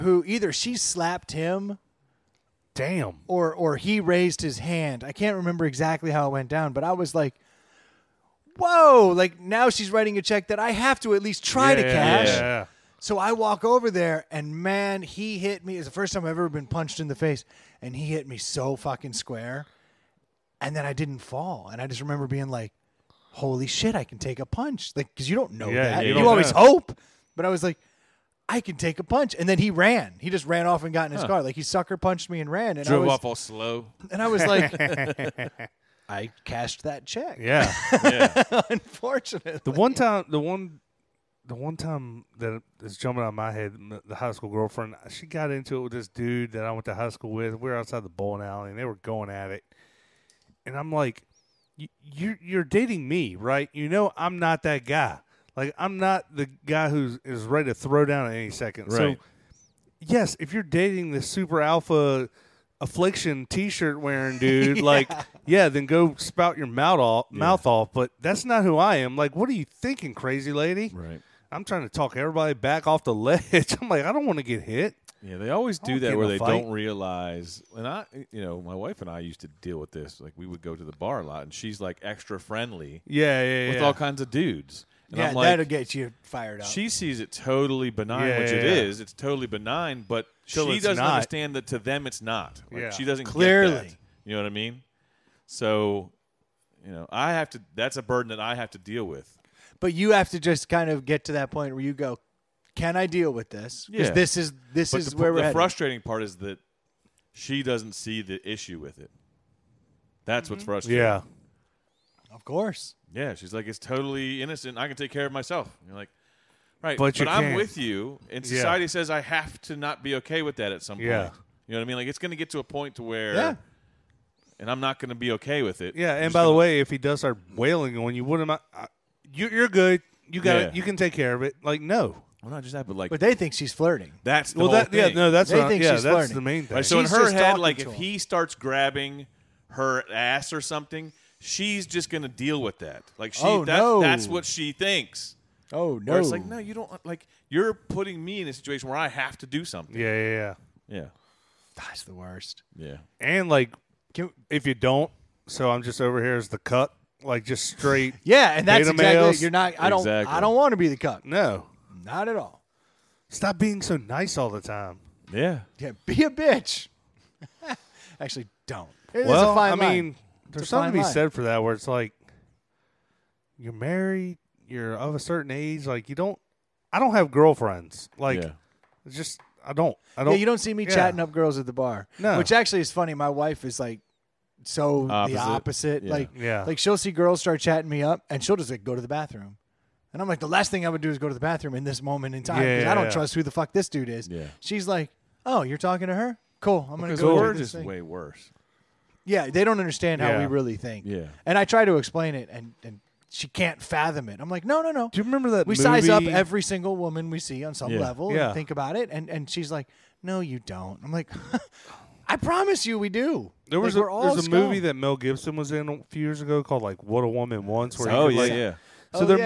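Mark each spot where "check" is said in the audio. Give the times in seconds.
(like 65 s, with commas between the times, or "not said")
10 s, 37 s.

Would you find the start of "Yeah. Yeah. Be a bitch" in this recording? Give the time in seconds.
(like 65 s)
165 s.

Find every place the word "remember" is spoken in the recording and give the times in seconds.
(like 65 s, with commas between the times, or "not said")
5 s, 22 s, 205 s.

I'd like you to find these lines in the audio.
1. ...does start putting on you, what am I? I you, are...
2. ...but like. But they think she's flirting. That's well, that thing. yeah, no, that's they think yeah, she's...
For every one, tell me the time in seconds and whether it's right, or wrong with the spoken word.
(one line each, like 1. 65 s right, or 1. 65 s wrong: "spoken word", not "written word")
1. 126 s wrong: "wailing", not "putting"
2. 132 s right.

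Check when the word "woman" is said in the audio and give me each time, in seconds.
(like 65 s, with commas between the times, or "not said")
206 s, 217 s.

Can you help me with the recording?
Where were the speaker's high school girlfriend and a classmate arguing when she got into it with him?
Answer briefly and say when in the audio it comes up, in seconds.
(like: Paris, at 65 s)
Outside the bowling alley, at 47 s.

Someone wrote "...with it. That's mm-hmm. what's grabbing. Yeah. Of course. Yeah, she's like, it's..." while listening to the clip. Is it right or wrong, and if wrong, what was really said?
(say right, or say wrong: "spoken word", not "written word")
wrong: "frustrating", not "grabbing".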